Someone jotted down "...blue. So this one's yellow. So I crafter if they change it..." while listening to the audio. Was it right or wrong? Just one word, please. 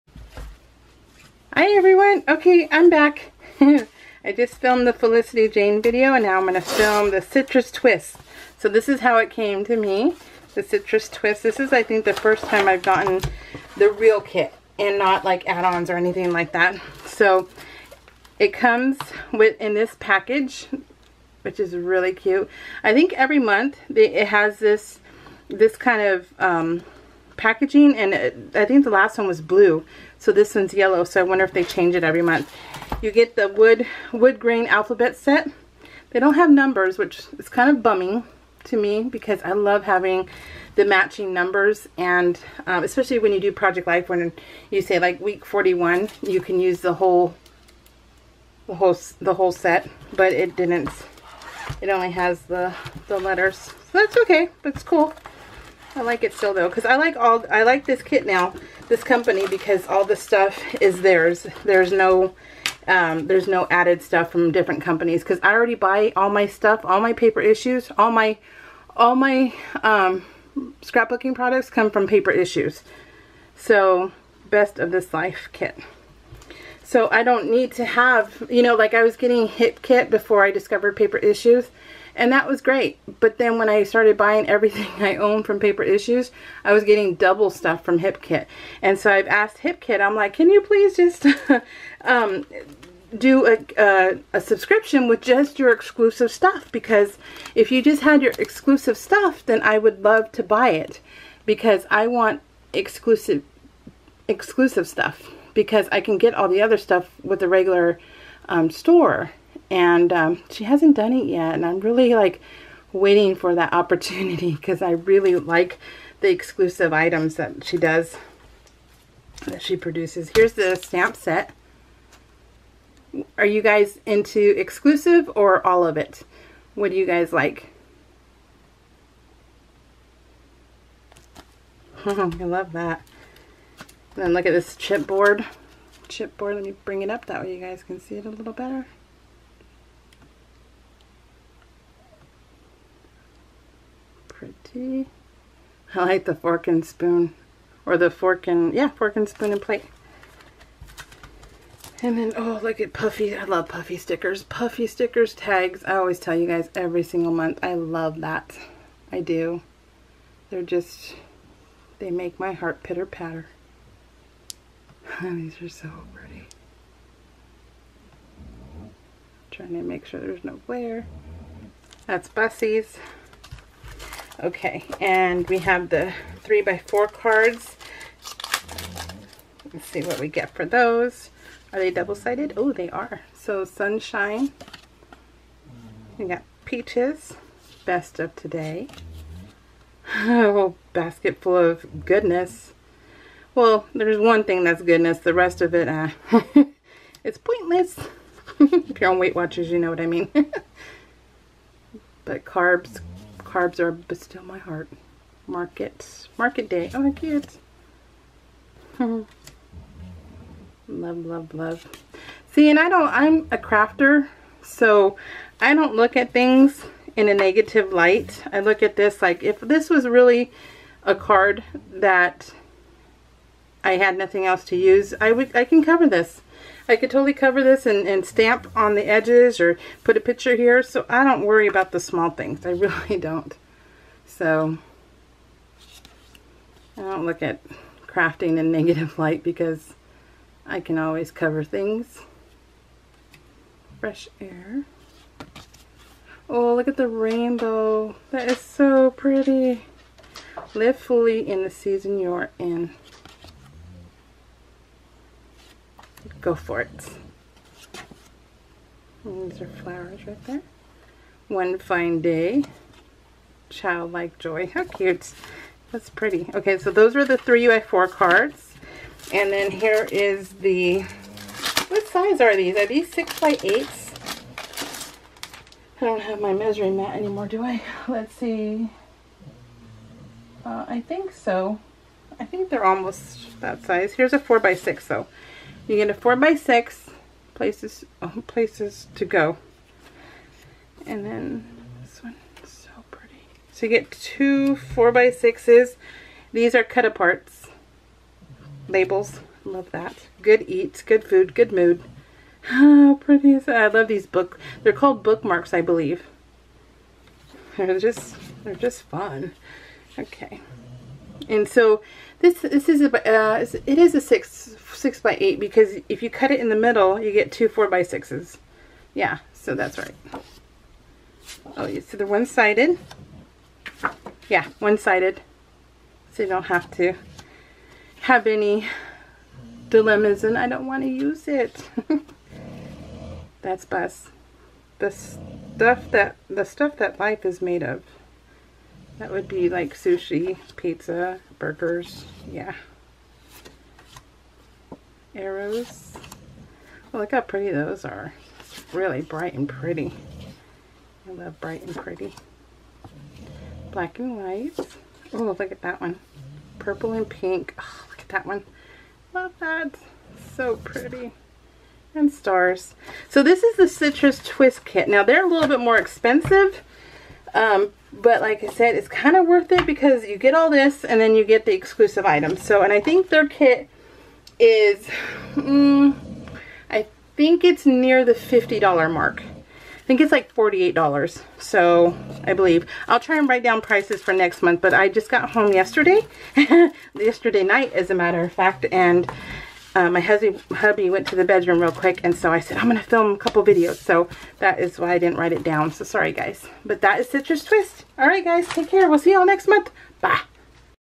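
wrong.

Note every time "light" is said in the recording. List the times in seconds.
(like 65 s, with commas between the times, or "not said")
217 s, 239 s.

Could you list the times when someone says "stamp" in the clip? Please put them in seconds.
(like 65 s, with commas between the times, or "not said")
120 s, 228 s.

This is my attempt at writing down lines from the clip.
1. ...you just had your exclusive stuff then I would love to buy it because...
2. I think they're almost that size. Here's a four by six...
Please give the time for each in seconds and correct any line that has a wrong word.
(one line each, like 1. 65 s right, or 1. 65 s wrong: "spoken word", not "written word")
1. 97 s right
2. 282 s right.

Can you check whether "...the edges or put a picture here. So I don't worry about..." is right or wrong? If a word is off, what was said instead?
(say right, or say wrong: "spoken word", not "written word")
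right.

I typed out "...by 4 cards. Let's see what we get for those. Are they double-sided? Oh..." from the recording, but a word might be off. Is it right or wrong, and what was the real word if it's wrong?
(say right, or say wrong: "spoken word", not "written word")
right.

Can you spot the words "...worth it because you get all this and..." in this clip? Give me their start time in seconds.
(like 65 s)
369 s.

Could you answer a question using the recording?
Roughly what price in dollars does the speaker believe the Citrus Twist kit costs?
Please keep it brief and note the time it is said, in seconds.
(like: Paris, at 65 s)
$48, at 380 s.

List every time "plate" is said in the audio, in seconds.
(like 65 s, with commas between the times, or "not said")
149 s.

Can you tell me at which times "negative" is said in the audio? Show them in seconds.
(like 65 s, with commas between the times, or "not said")
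217 s, 238 s.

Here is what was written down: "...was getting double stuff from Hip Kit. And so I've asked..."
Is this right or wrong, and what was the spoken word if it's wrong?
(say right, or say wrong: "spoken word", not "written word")
right.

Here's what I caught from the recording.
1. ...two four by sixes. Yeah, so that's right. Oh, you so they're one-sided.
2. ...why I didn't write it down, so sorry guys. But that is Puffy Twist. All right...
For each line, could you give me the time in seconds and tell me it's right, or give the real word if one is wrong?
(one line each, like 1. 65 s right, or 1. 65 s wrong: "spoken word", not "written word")
1. 317 s right
2. 394 s wrong: "Citrus", not "Puffy".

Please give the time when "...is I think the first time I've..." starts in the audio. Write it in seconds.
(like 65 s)
11 s.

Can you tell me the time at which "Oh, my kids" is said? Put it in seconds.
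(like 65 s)
206 s.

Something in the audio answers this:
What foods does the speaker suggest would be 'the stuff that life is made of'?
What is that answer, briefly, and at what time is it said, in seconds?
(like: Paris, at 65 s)
Sushi, pizza, burgers, at 339 s.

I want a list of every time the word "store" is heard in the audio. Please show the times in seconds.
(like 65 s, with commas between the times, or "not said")
108 s.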